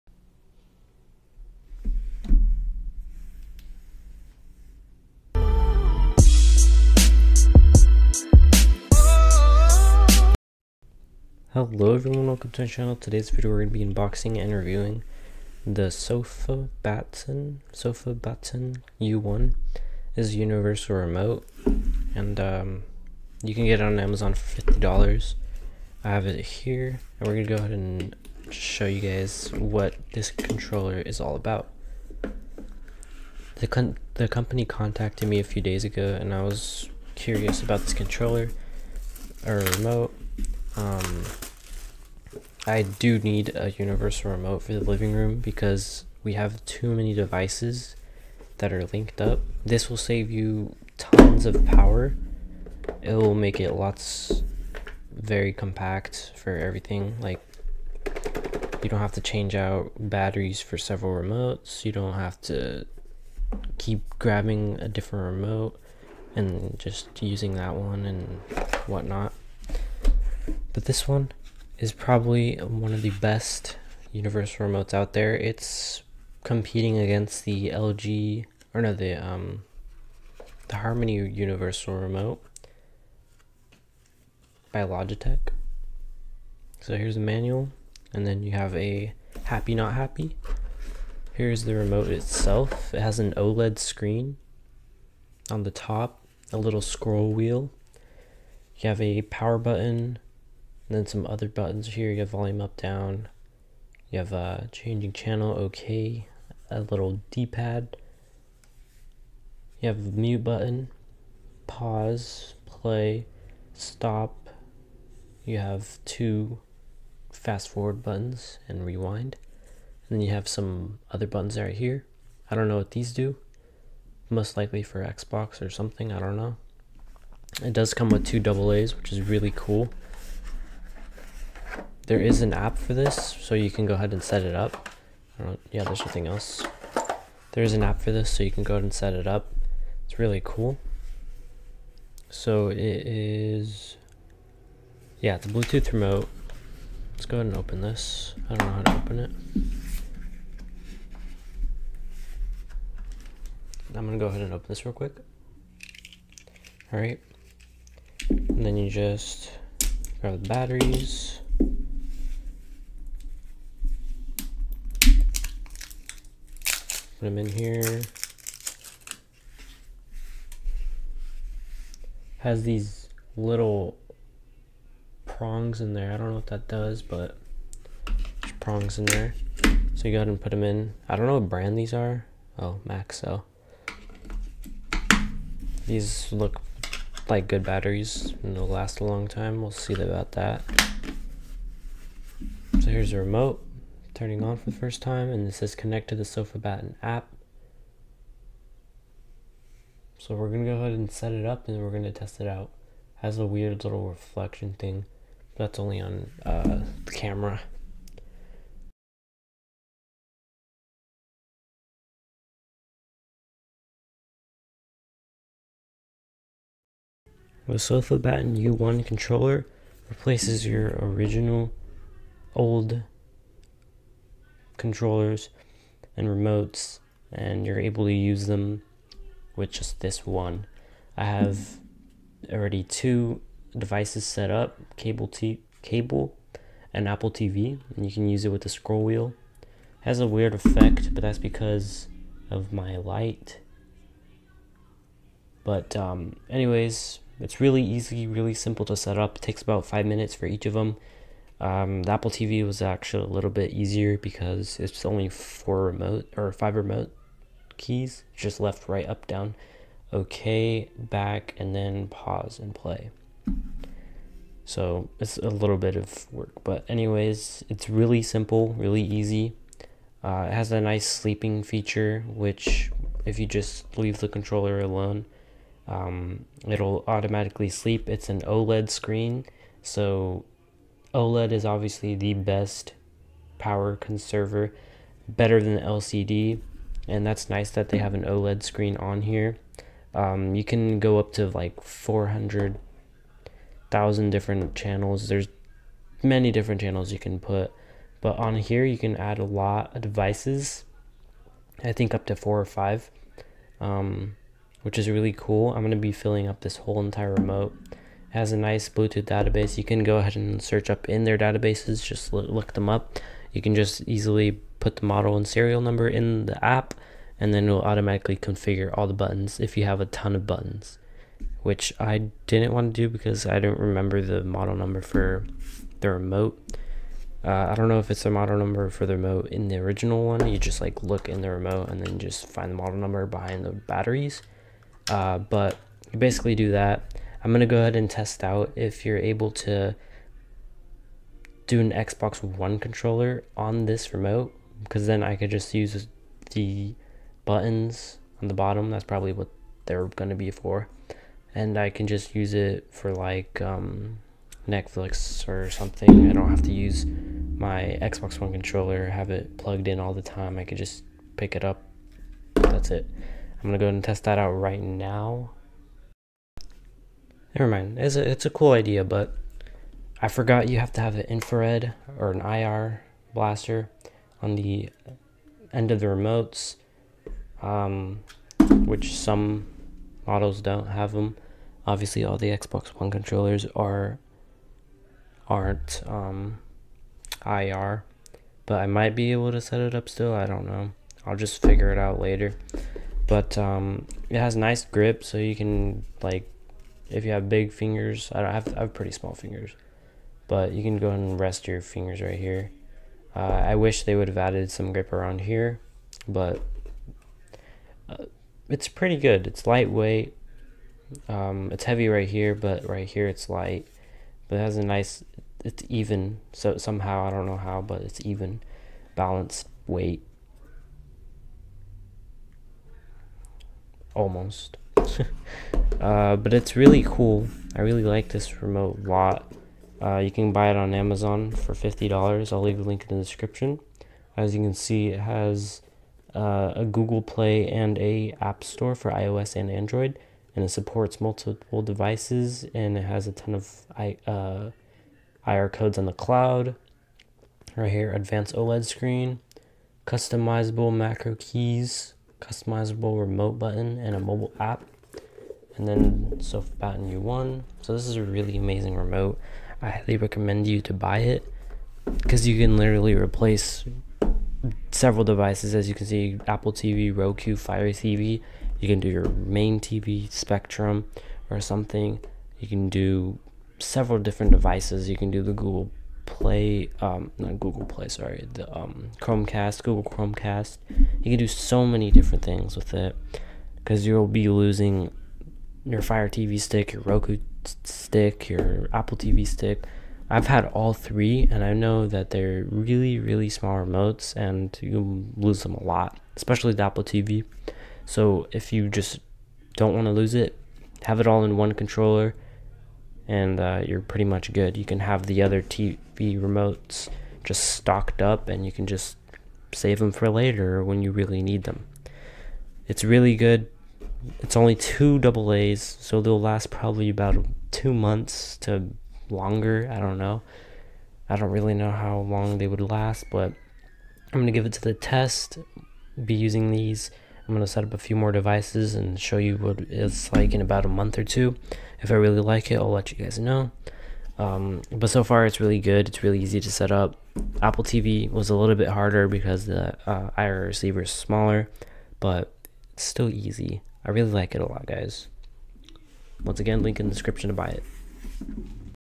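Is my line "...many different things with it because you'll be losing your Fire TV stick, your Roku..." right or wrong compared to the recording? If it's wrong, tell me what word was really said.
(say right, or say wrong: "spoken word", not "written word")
right.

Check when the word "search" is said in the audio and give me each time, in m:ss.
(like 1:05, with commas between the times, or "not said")
5:10.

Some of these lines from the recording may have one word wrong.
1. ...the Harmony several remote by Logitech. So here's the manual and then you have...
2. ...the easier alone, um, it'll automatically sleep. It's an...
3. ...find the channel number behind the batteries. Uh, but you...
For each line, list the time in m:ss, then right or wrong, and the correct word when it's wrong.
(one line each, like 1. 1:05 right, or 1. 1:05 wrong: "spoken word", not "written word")
1. 1:20 wrong: "universal", not "several"
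2. 4:34 wrong: "controller", not "easier"
3. 5:32 wrong: "model", not "channel".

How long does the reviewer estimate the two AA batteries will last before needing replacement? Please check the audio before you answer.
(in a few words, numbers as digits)
about two months.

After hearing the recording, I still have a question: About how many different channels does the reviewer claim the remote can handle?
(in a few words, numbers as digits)
400,000.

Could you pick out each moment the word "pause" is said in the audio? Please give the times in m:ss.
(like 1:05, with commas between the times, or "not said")
1:51, 4:22.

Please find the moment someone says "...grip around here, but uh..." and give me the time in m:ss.
6:44.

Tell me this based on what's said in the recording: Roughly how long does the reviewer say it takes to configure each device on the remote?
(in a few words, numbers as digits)
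five minutes.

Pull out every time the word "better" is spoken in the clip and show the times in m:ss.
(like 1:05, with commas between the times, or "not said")
4:45.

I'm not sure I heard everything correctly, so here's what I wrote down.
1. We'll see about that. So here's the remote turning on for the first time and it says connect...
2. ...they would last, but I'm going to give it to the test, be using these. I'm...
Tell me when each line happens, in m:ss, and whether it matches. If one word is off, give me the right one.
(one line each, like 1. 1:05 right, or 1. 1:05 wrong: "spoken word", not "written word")
1. 3:09 right
2. 8:42 right.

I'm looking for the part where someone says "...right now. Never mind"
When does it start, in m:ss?
6:04.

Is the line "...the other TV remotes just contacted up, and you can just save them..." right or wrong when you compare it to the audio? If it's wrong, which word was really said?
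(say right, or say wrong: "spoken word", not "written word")
wrong: "stocked", not "contacted".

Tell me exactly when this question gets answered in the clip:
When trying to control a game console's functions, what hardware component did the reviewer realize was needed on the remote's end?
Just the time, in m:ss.
6:12.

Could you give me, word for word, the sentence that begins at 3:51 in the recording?
I have already two devices set up, cable t- cable and Apple TV, and you can use it with the scroll wheel.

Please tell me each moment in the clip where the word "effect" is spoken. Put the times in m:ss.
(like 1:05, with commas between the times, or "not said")
4:00.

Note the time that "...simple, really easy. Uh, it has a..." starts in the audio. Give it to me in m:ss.
4:28.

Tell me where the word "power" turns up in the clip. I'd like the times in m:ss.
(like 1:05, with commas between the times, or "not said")
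0:51, 1:39, 4:43.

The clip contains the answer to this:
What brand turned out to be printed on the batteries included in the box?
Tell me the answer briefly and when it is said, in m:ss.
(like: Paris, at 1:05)
Maxell, at 3:02.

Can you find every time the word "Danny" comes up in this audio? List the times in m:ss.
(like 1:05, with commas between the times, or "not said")
not said.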